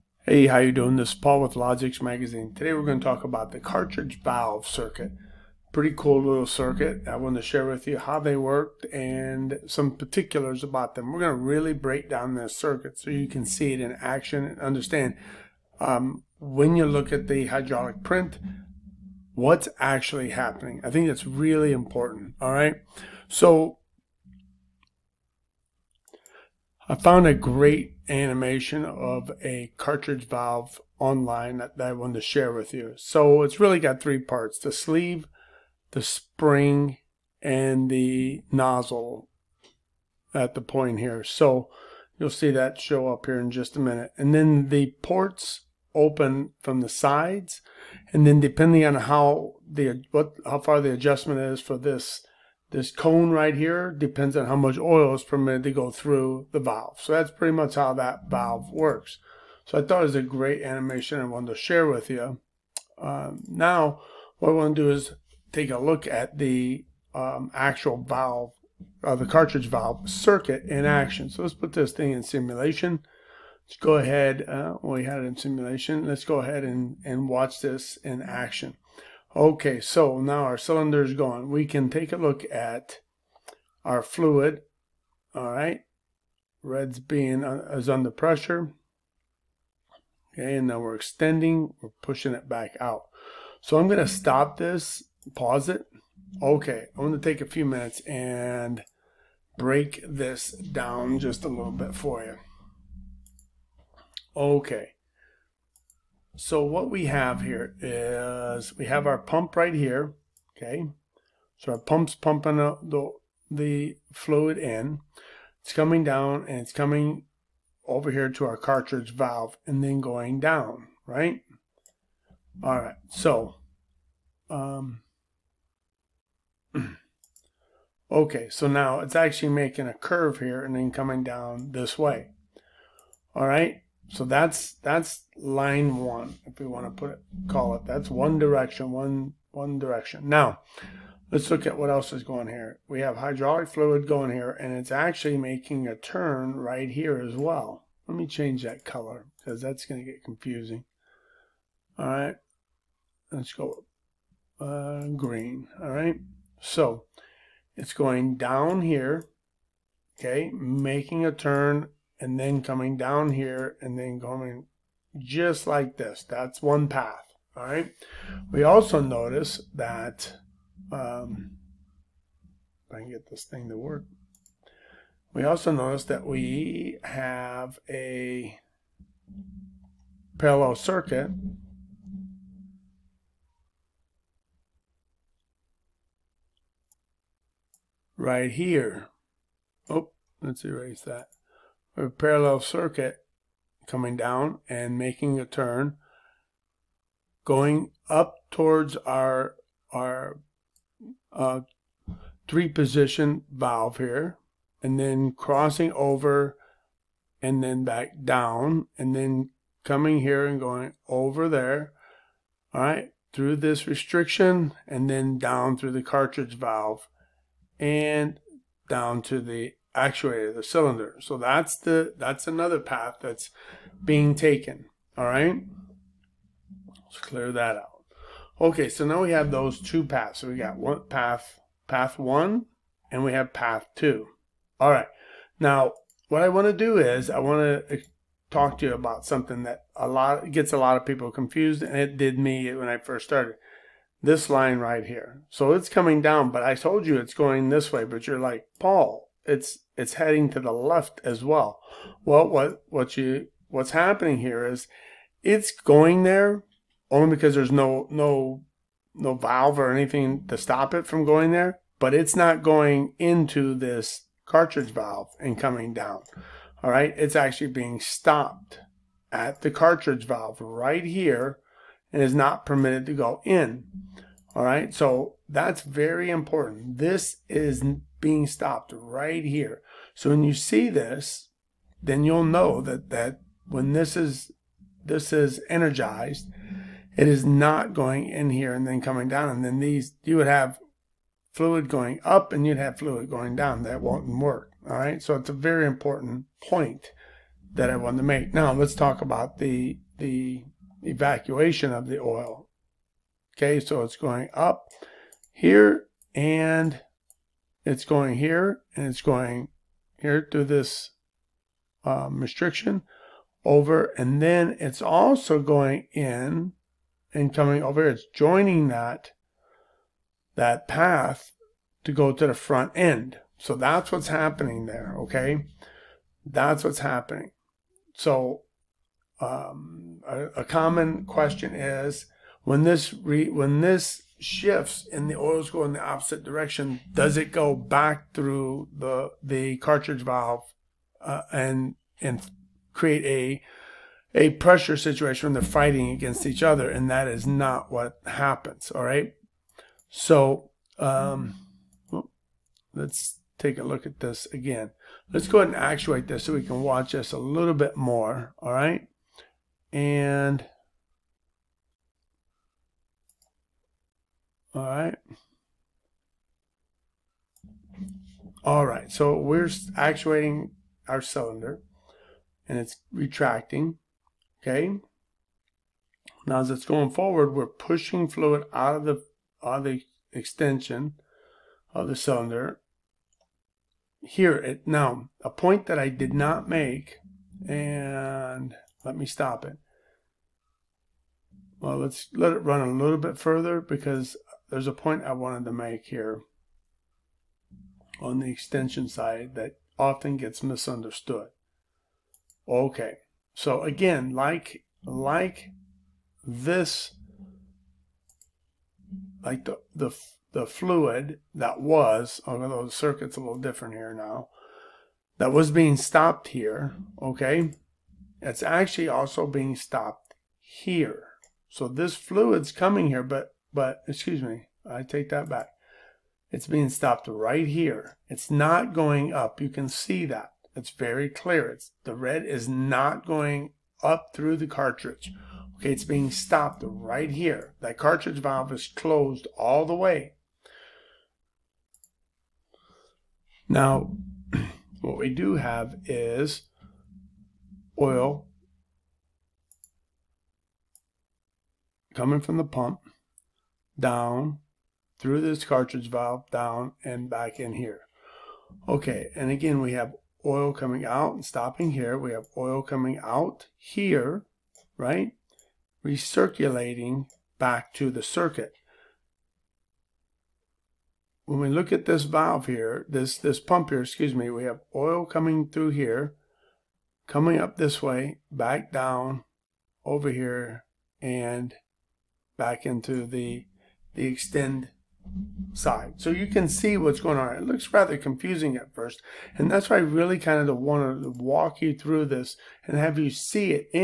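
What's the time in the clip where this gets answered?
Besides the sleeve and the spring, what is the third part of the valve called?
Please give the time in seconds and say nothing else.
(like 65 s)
37 s.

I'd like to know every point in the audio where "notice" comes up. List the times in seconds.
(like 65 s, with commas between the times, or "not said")
169 s, 175 s.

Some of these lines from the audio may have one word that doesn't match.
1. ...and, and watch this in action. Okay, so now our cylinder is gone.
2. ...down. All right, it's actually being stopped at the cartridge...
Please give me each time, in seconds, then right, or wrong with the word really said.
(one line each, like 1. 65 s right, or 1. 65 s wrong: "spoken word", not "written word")
1. 76 s right
2. 265 s right.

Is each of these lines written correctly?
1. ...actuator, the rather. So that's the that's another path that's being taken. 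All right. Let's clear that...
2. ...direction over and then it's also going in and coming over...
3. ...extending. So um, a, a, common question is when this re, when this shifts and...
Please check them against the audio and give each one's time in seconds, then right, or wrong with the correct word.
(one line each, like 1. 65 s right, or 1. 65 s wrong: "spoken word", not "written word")
1. 219 s wrong: "cylinder", not "rather"
2. 312 s wrong: "restriction", not "direction"
3. 327 s wrong: "happening", not "extending".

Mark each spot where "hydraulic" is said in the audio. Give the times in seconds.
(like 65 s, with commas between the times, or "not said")
17 s, 143 s.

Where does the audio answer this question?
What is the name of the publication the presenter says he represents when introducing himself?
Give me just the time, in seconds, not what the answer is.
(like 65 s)
1 s.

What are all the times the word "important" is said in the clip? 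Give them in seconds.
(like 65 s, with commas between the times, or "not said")
21 s, 276 s, 295 s.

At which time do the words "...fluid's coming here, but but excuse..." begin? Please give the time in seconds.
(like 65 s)
422 s.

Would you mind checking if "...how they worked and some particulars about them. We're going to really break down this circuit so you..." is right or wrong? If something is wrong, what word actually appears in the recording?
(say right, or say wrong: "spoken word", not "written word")
right.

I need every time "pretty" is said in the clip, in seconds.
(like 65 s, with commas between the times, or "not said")
5 s, 57 s.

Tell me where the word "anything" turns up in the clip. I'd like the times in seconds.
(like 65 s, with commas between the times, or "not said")
259 s.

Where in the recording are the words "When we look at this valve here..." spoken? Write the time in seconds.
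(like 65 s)
471 s.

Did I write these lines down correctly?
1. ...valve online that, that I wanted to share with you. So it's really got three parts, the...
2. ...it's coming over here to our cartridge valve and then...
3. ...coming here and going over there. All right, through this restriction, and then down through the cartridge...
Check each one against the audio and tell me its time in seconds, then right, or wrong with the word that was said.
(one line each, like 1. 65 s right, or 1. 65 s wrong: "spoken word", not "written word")
1. 30 s right
2. 116 s right
3. 209 s right.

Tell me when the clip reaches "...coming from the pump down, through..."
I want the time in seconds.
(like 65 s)
452 s.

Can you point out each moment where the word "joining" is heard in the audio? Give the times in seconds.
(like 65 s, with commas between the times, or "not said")
318 s.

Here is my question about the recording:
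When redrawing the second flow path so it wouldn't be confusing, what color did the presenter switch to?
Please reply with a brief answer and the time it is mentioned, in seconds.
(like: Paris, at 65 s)
Green, at 155 s.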